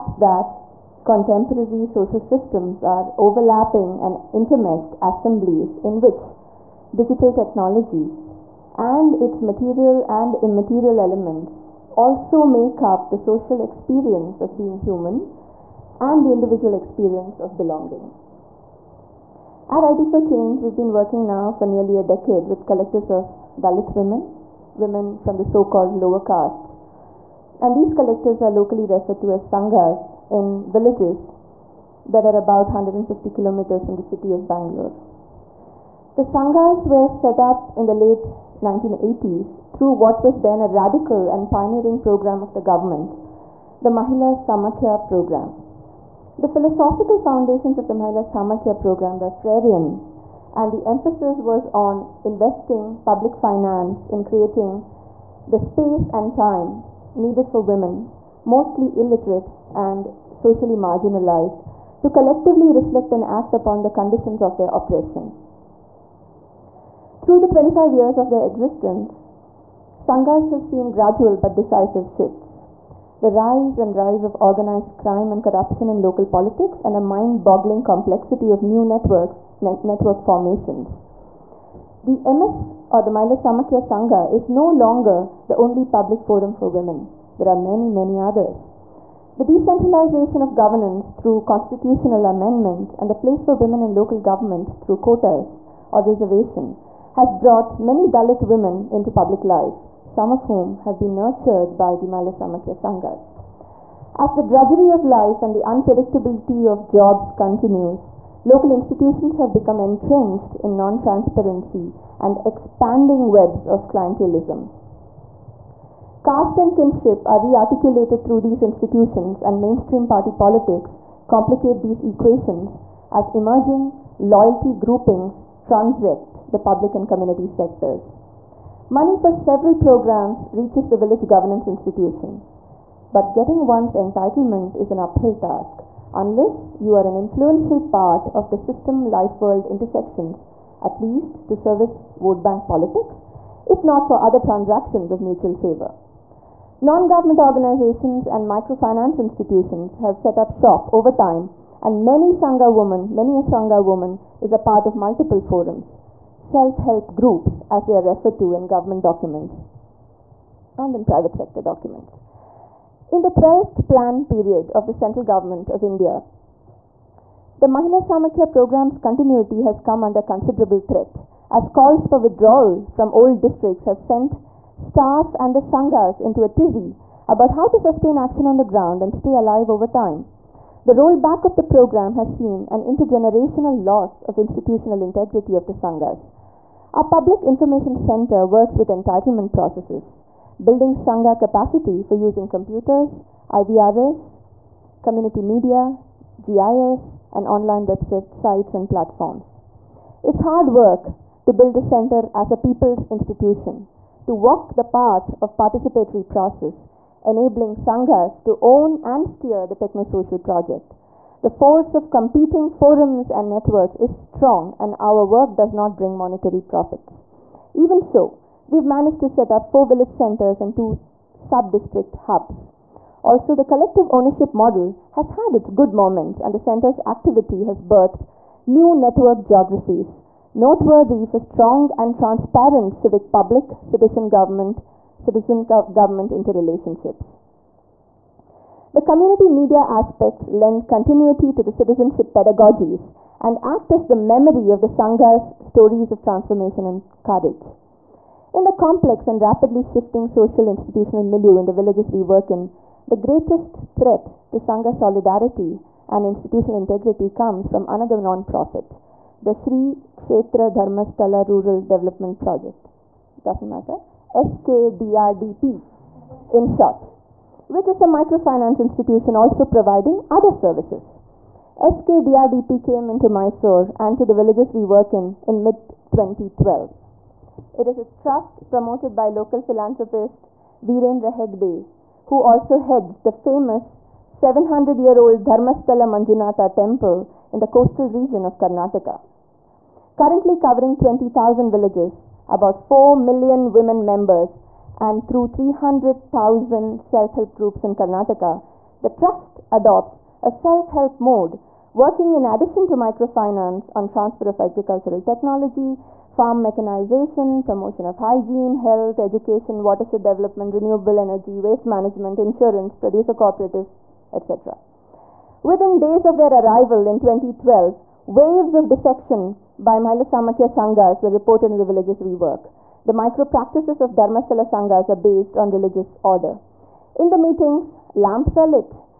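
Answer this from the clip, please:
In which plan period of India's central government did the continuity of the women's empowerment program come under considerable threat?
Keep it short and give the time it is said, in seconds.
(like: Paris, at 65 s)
12th plan period, at 163 s.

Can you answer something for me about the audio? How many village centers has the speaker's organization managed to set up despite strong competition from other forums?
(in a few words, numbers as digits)
4.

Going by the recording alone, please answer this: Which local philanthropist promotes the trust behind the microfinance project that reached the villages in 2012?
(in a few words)
Virendra Hegde.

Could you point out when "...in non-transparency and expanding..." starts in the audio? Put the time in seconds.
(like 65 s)
110 s.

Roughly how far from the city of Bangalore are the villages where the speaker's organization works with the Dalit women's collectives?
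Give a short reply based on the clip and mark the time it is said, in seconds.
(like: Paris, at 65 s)
150 kilometers, at 32 s.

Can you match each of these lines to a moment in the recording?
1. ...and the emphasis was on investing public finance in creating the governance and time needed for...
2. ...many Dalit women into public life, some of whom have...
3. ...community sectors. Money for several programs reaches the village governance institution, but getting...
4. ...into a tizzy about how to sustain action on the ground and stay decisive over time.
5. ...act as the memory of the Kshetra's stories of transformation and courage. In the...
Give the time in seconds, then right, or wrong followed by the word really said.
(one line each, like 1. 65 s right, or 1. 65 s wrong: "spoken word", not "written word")
1. 50 s wrong: "space", not "governance"
2. 97 s right
3. 127 s right
4. 176 s wrong: "alive", not "decisive"
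5. 243 s wrong: "Sangha", not "Kshetra".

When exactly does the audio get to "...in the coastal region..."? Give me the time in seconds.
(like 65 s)
287 s.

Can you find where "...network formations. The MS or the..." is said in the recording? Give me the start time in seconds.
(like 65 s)
79 s.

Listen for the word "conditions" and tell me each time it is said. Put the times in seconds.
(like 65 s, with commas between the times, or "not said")
63 s.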